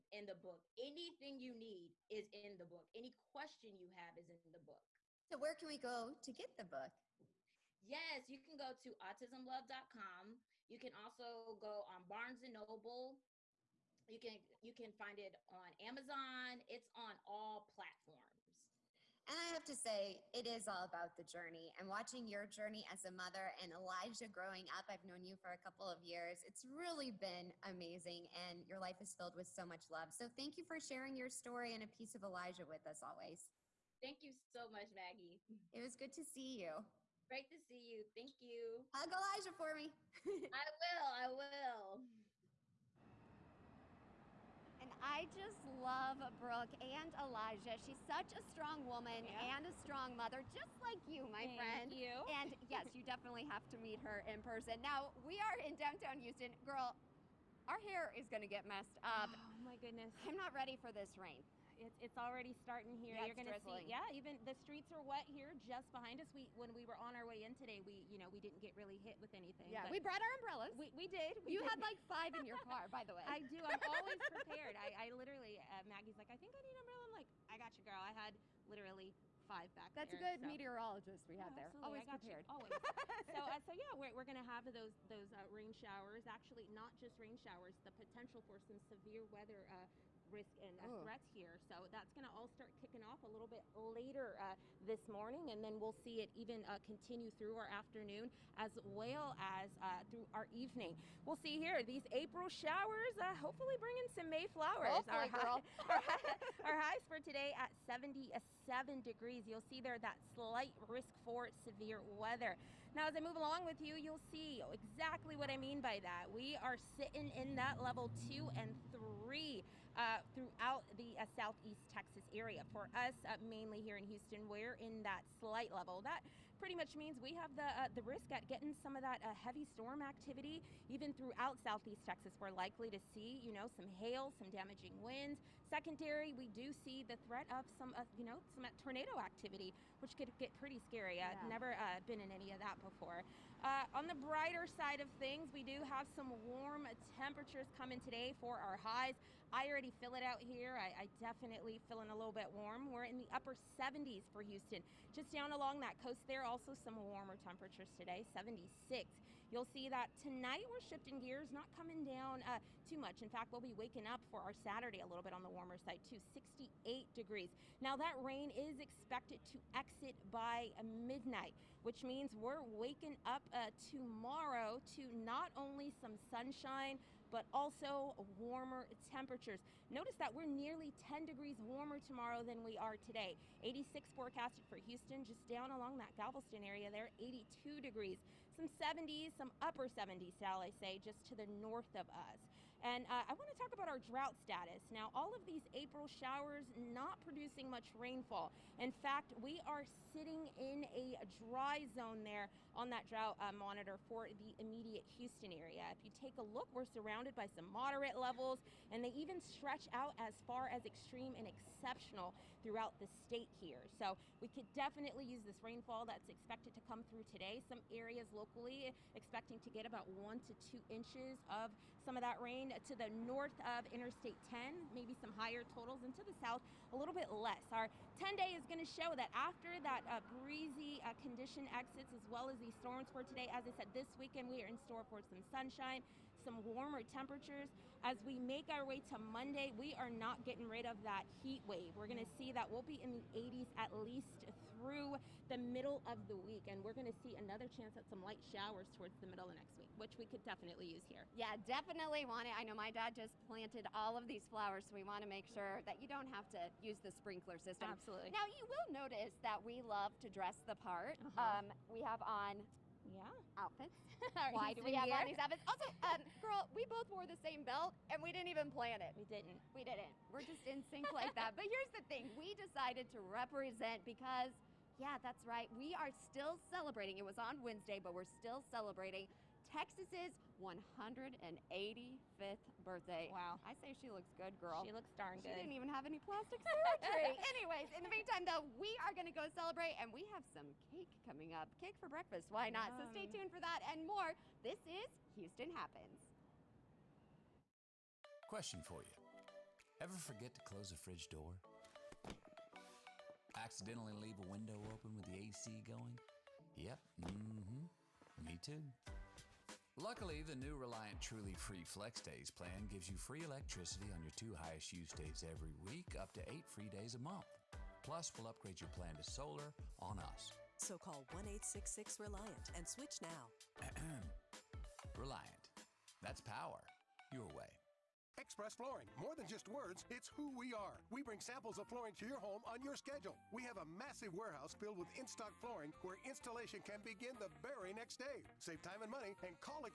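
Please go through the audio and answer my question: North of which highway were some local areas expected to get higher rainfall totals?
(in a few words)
Interstate 10.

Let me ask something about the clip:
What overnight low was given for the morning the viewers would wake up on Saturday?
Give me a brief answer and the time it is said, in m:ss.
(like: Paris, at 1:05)
68 degrees, at 2:46.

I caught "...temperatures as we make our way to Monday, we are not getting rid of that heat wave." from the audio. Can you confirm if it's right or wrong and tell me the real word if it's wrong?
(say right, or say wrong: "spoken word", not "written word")
right.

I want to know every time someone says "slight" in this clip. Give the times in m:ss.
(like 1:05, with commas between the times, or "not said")
1:50, 2:05.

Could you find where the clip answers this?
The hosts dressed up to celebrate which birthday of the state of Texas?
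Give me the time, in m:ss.
4:40.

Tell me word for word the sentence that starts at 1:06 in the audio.
We when we were on our way in today, we you know we didn't get really hit with anything.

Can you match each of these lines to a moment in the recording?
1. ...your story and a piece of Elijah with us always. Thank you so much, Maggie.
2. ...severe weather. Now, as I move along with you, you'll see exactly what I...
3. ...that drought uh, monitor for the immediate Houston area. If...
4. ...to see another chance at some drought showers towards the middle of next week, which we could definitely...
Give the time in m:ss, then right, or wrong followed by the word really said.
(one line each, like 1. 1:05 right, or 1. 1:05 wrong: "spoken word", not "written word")
1. 0:31 right
2. 1:51 right
3. 3:22 right
4. 4:07 wrong: "light", not "drought".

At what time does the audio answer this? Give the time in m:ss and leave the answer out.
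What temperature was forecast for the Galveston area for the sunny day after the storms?
3:07.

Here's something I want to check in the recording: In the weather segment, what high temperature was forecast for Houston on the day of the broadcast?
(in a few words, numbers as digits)
77 degrees.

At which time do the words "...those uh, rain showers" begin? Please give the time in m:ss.
1:25.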